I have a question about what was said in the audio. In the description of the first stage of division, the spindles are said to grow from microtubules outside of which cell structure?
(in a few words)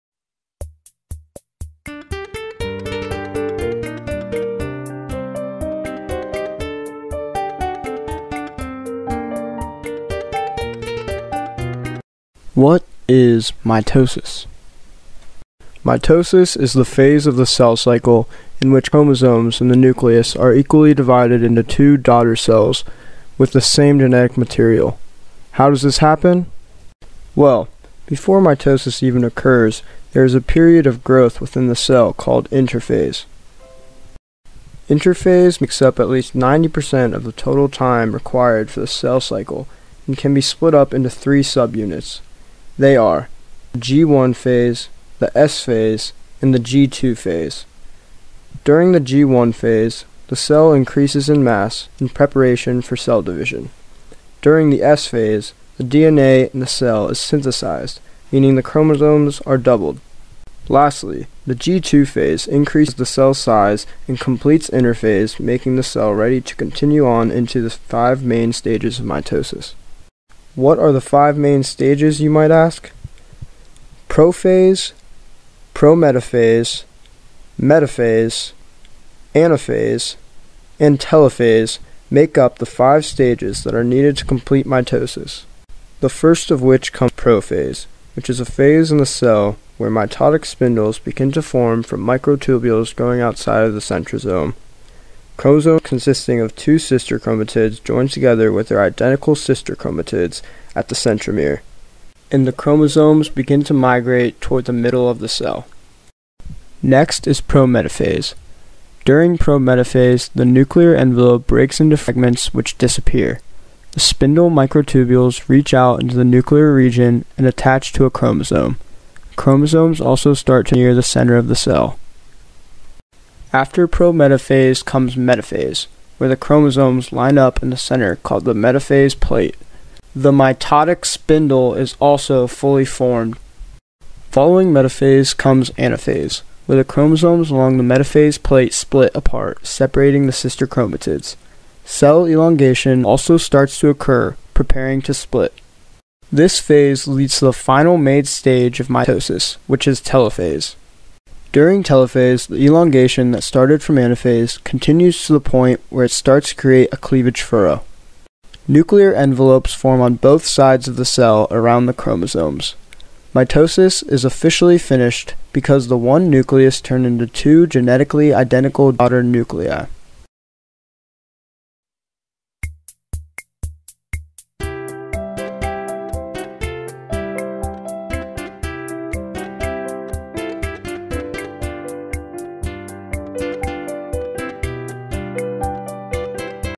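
centrosome.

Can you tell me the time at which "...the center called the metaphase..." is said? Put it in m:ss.
2:07.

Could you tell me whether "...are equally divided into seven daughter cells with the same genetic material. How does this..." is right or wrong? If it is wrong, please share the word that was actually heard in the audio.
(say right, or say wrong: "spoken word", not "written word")
wrong: "two", not "seven".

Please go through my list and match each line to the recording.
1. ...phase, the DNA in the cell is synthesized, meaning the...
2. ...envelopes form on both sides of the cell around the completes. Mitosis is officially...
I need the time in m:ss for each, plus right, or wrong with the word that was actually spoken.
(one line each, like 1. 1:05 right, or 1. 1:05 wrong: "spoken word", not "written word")
1. 0:55 right
2. 2:39 wrong: "chromosomes", not "completes".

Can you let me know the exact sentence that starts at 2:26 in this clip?
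This phase leads to the final made stage of mitosis, which is telophase.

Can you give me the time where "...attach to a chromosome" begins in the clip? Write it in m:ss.
1:57.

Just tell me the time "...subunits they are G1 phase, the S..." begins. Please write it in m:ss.
0:41.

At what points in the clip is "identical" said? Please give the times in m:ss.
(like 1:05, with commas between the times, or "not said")
1:38, 2:48.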